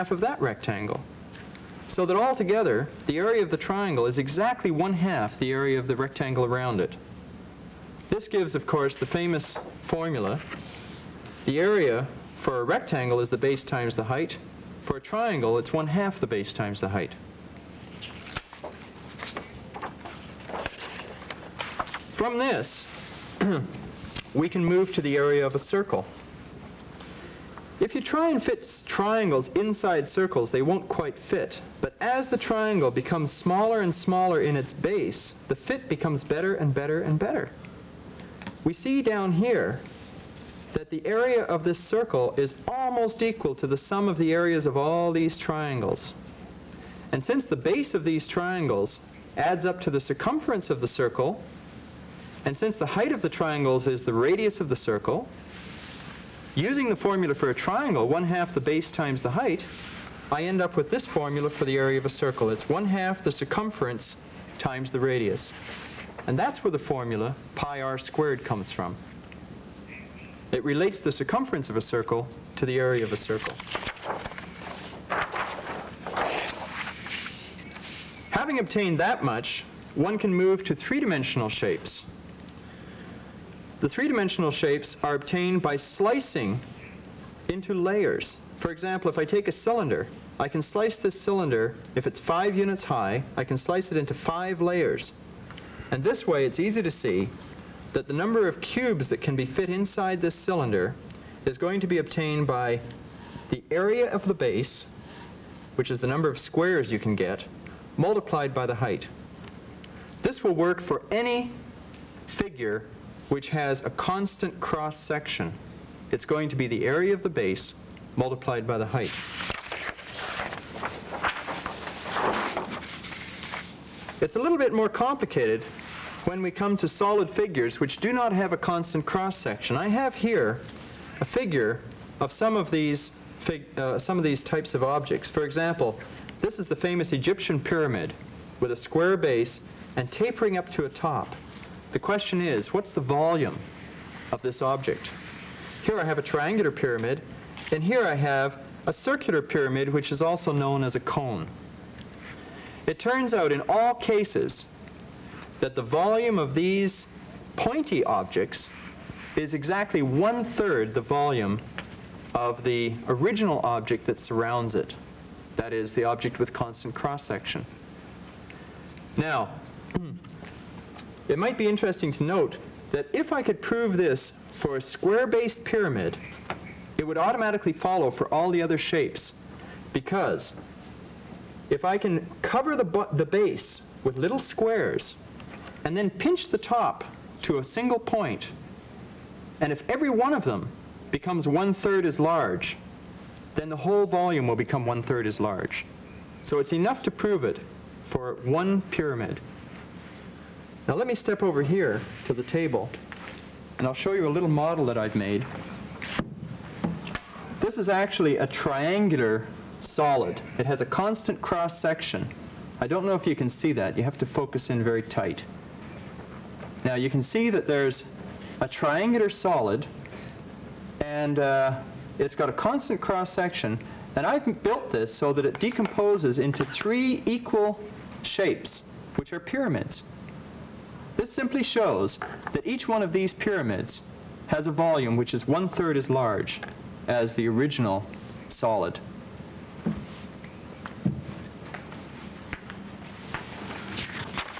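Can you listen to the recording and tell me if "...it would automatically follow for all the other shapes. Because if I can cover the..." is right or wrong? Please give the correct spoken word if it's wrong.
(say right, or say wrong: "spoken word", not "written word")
right.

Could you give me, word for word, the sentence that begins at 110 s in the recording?
This will work for any figure which has a constant cross-section.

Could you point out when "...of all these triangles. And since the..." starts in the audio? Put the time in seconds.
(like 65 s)
44 s.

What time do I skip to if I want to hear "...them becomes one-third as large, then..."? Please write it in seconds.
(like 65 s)
190 s.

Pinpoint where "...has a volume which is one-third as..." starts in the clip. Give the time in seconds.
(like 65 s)
234 s.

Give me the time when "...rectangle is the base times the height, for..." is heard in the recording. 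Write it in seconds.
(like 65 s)
12 s.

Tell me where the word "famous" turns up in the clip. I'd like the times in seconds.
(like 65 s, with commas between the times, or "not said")
9 s, 136 s.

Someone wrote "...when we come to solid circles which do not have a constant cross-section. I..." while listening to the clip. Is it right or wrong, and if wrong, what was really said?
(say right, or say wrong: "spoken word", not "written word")
wrong: "figures", not "circles".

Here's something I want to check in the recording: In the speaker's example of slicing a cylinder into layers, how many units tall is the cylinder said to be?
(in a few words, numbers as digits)
5.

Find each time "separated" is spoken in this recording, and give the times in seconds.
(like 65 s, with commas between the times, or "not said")
not said.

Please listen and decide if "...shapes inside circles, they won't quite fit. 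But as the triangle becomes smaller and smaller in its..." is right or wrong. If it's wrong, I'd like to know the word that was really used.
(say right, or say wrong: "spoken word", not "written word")
wrong: "triangles", not "shapes".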